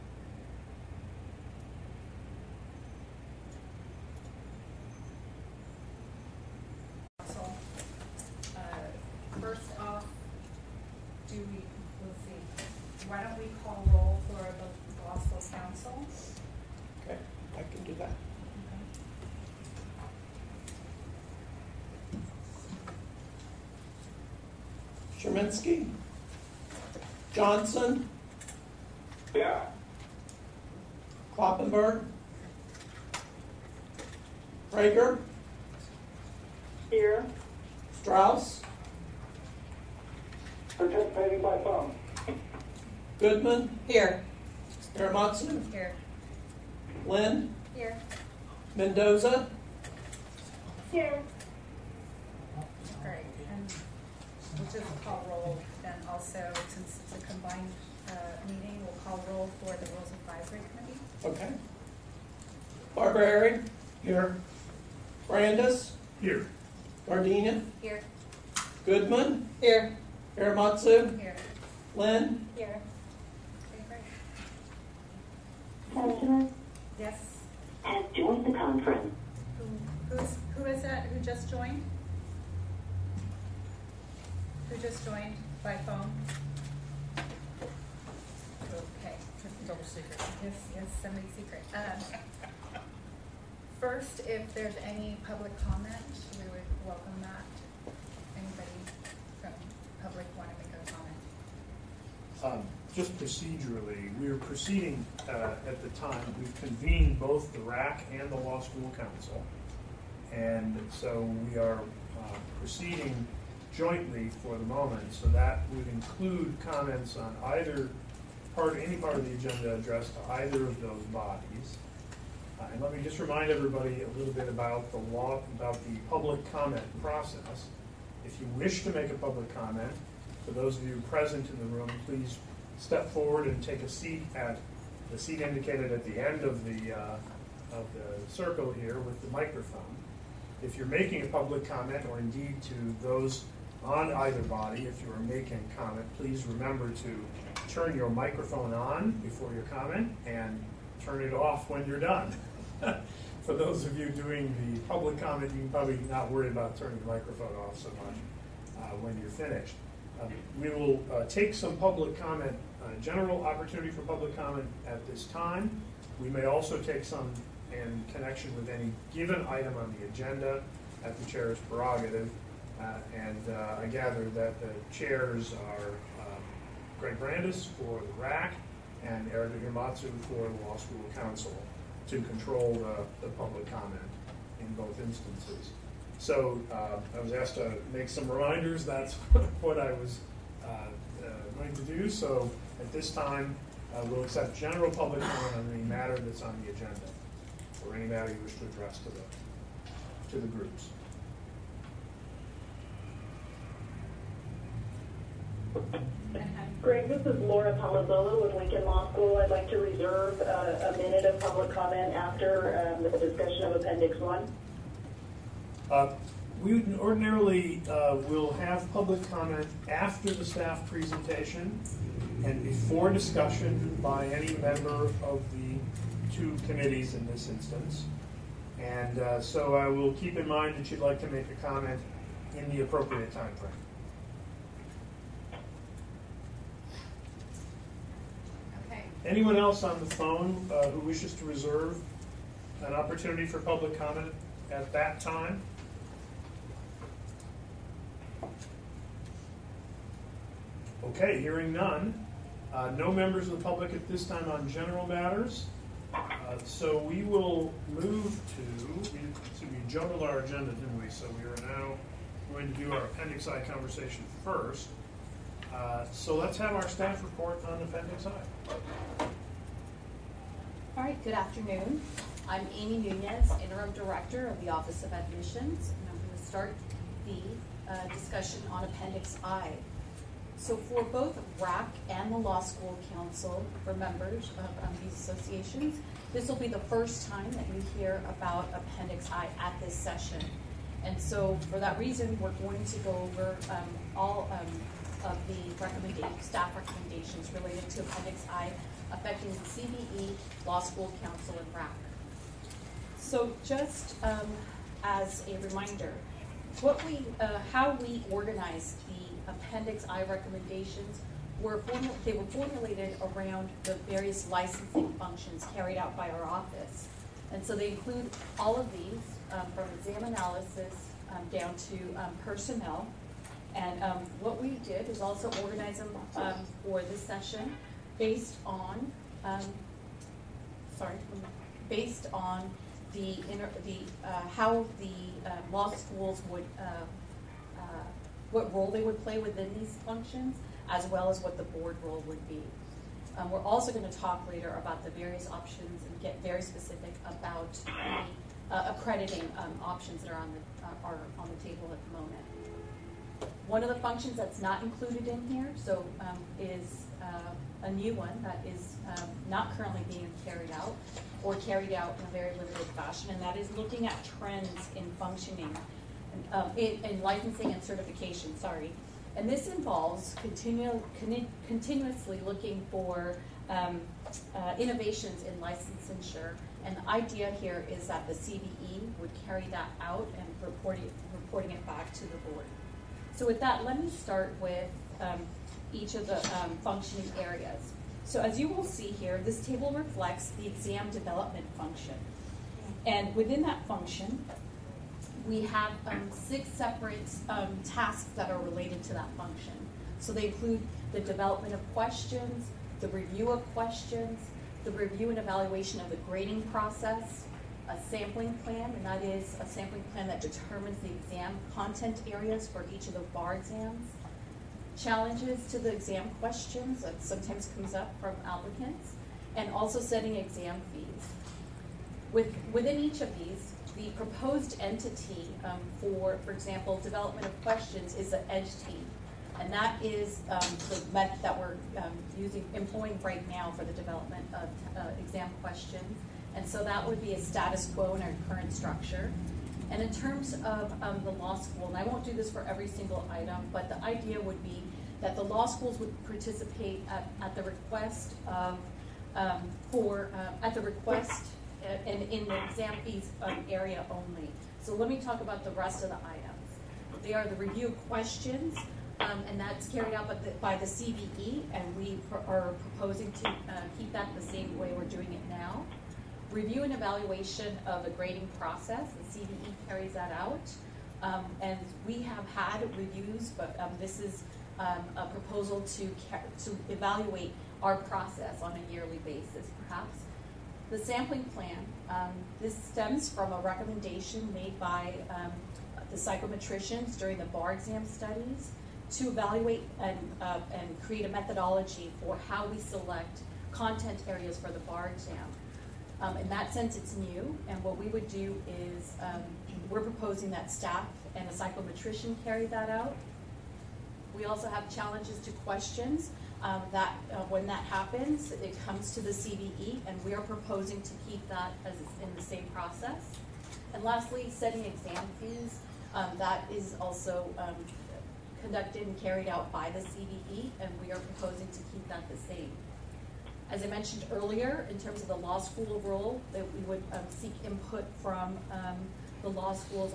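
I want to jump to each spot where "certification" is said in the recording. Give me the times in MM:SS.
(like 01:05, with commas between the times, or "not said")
06:07.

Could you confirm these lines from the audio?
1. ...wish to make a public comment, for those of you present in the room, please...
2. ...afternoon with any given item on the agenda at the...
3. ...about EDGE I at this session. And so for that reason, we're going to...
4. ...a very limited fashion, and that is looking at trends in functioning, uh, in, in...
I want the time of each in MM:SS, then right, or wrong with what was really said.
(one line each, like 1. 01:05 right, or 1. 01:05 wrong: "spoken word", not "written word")
1. 02:08 right
2. 02:48 wrong: "connection", not "afternoon"
3. 04:48 wrong: "Appendix", not "EDGE"
4. 06:02 right.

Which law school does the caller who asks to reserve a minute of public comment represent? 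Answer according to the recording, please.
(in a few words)
Lincoln Law School.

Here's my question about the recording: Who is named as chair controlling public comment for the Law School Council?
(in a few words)
Erica Yamatsu.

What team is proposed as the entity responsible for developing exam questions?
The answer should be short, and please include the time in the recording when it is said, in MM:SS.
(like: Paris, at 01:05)
EDGE team, at 07:08.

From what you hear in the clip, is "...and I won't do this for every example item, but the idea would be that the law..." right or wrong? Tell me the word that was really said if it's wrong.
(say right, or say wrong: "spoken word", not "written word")
wrong: "single", not "example".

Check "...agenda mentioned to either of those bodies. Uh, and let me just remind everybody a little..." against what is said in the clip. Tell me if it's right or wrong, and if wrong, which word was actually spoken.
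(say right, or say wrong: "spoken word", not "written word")
wrong: "addressed", not "mentioned".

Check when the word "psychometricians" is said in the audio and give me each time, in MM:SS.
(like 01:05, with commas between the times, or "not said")
08:06, 08:21.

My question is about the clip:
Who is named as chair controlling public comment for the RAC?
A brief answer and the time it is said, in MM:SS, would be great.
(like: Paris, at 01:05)
Greg Brandis, at 02:56.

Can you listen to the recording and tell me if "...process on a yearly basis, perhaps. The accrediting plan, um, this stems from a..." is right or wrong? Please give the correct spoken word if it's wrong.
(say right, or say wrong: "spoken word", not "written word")
wrong: "sampling", not "accrediting".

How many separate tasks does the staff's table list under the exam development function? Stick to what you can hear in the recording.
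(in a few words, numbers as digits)
6.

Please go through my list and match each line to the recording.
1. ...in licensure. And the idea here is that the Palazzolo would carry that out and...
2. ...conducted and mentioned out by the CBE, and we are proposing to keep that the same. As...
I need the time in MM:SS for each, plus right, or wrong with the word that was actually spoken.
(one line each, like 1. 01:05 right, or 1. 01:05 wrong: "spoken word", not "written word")
1. 06:15 wrong: "CBE", not "Palazzolo"
2. 08:38 wrong: "carried", not "mentioned".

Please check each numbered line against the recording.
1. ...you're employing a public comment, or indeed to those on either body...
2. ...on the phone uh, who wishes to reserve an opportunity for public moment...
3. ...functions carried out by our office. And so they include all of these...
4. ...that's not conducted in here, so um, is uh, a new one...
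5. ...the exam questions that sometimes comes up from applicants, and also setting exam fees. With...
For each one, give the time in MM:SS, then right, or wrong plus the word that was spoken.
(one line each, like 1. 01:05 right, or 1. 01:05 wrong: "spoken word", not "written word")
1. 02:20 wrong: "making", not "employing"
2. 03:59 wrong: "comment", not "moment"
3. 05:15 right
4. 05:54 wrong: "included", not "conducted"
5. 06:55 right.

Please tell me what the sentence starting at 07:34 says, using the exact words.
So let me talk about the rest of the items.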